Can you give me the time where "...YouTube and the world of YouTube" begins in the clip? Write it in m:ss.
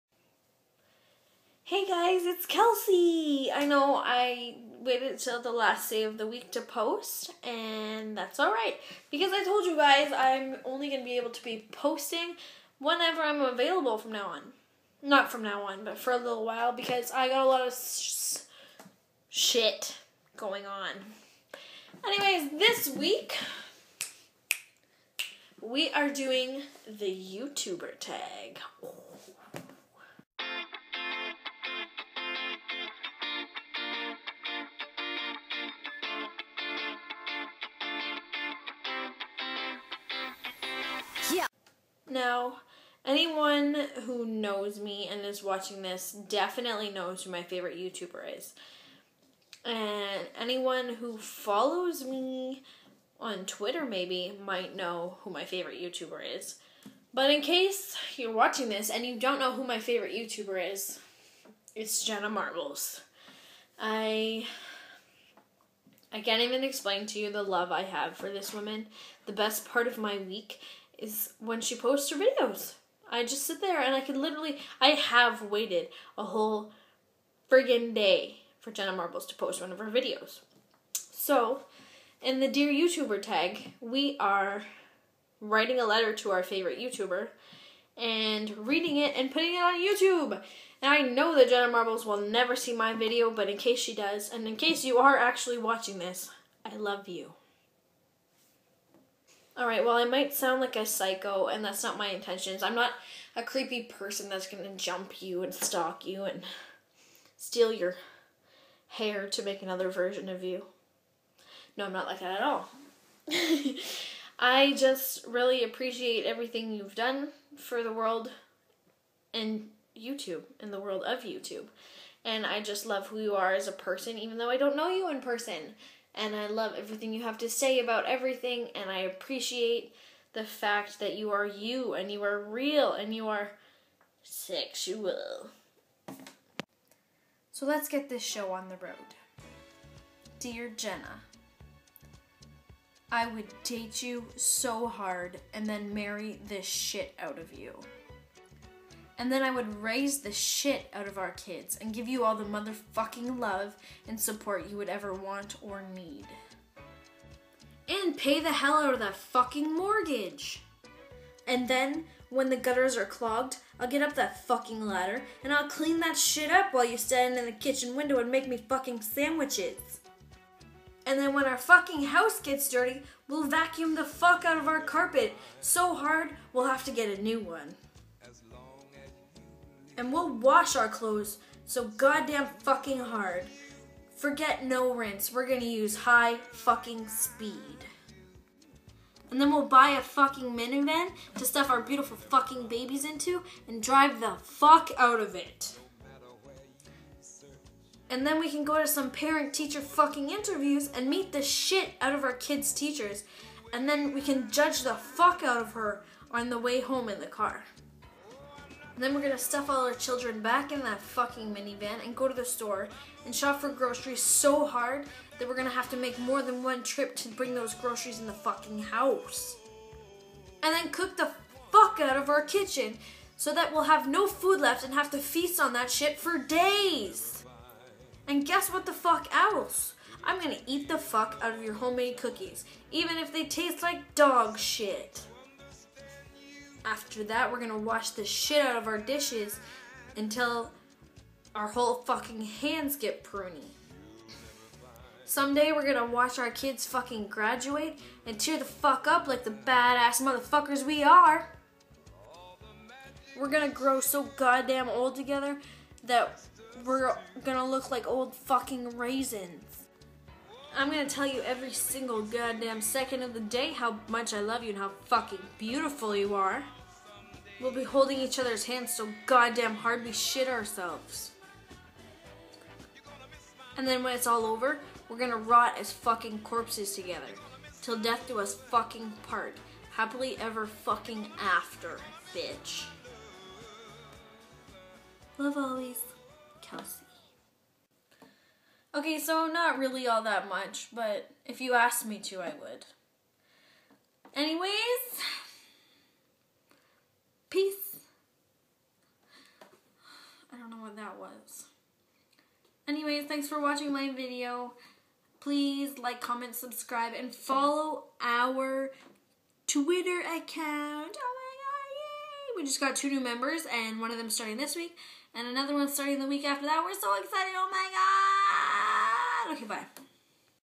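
1:59.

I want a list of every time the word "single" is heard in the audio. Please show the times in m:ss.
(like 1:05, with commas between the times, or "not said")
4:21.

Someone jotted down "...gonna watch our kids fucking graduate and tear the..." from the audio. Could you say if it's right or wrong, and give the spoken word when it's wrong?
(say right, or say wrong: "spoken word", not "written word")
right.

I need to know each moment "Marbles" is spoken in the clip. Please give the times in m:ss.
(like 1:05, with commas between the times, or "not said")
1:02, 1:18, 1:31.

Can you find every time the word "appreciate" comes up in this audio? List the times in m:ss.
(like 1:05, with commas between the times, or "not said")
1:55, 2:08.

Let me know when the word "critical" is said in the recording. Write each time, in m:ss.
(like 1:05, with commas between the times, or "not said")
not said.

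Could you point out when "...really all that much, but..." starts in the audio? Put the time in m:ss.
4:49.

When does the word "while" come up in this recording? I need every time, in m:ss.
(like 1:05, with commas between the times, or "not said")
0:16, 2:46.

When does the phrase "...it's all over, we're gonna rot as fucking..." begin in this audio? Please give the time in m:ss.
4:34.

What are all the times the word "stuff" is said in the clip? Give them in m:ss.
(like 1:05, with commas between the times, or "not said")
3:11, 3:29.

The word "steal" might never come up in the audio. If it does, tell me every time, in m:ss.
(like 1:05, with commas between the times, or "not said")
1:47.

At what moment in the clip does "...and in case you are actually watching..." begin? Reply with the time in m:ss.
1:34.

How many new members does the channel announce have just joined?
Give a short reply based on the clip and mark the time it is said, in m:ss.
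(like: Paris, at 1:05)
2, at 5:12.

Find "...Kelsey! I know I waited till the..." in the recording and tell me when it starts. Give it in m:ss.
0:02.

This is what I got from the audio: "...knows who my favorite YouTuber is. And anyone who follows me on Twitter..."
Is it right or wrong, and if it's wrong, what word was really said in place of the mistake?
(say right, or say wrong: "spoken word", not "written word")
right.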